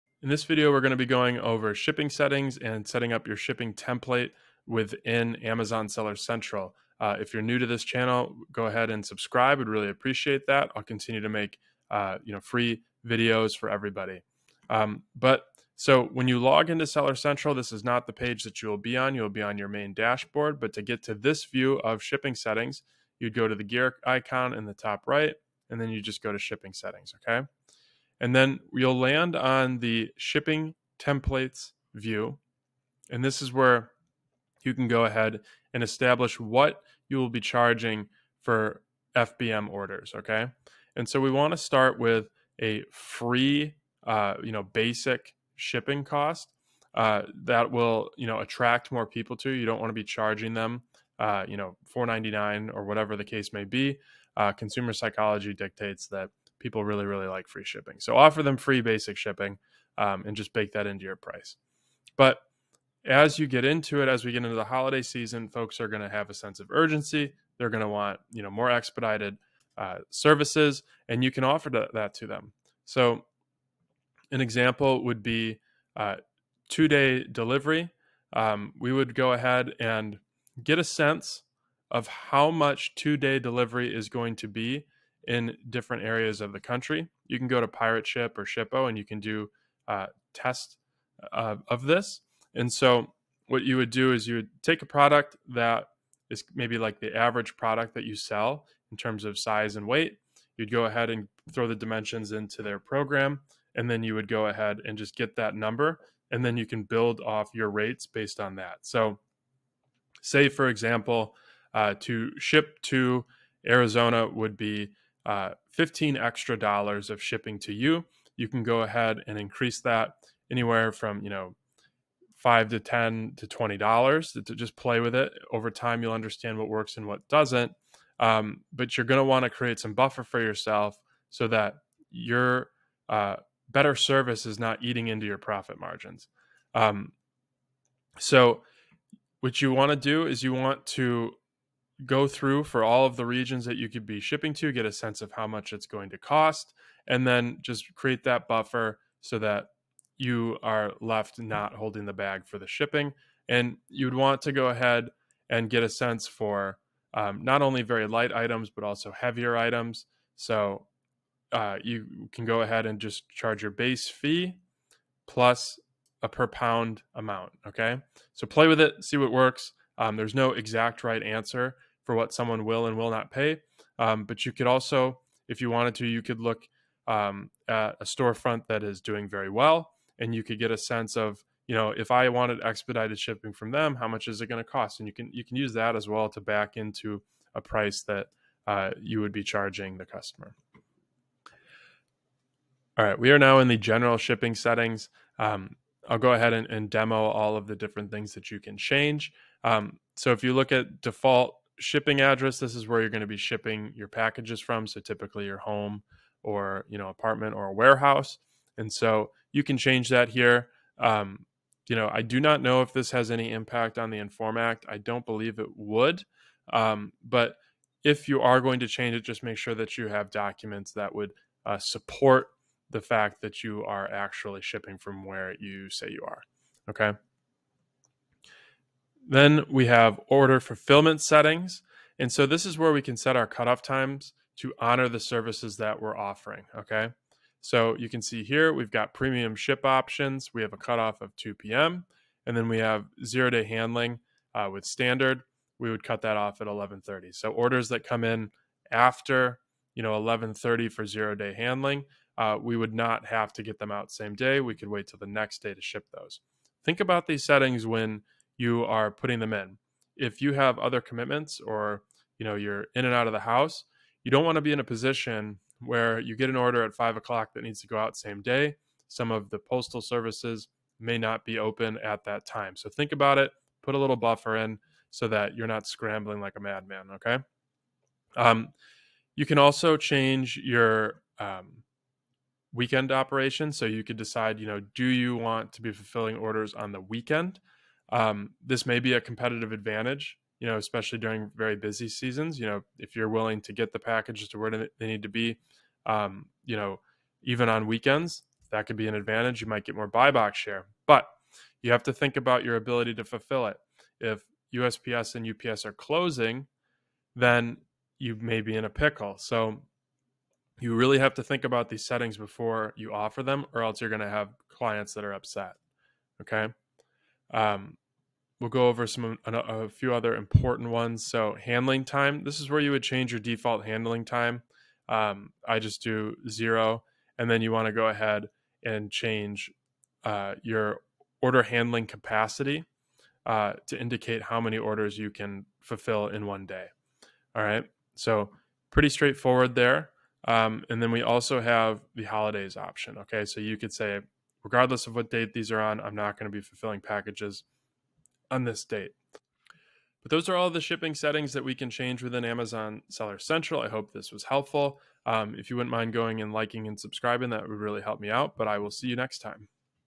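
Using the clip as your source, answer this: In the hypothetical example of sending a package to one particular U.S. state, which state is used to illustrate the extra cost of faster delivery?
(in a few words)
Arizona.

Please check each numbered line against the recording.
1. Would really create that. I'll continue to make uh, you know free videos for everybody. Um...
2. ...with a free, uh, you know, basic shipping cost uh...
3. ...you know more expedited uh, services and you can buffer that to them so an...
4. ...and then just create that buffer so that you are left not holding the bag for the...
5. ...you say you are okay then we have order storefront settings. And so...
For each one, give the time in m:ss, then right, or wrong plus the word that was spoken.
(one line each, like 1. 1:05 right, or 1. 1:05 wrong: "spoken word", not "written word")
1. 0:09 wrong: "appreciate", not "create"
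2. 0:41 right
3. 1:08 wrong: "offer", not "buffer"
4. 2:27 right
5. 3:45 wrong: "fulfillment", not "storefront".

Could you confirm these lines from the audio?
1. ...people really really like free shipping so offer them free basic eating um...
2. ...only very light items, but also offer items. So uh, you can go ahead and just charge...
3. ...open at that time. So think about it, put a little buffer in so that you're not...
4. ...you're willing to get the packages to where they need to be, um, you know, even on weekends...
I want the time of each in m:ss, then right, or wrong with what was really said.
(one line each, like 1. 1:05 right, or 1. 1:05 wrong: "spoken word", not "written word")
1. 0:56 wrong: "shipping", not "eating"
2. 2:37 wrong: "heavier", not "offer"
3. 4:31 right
4. 4:53 right.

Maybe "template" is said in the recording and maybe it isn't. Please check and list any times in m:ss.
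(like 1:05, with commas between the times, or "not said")
0:03, 0:30.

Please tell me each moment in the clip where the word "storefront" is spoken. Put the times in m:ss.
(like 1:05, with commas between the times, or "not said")
2:58.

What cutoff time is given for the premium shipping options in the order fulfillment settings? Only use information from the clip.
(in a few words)
2 p.m.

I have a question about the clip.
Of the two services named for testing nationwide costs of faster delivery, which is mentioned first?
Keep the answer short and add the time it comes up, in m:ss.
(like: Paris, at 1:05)
Pirate Ship, at 1:27.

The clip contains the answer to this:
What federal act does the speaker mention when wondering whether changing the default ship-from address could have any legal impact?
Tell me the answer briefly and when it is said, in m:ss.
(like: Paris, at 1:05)
INFORM Act, at 3:34.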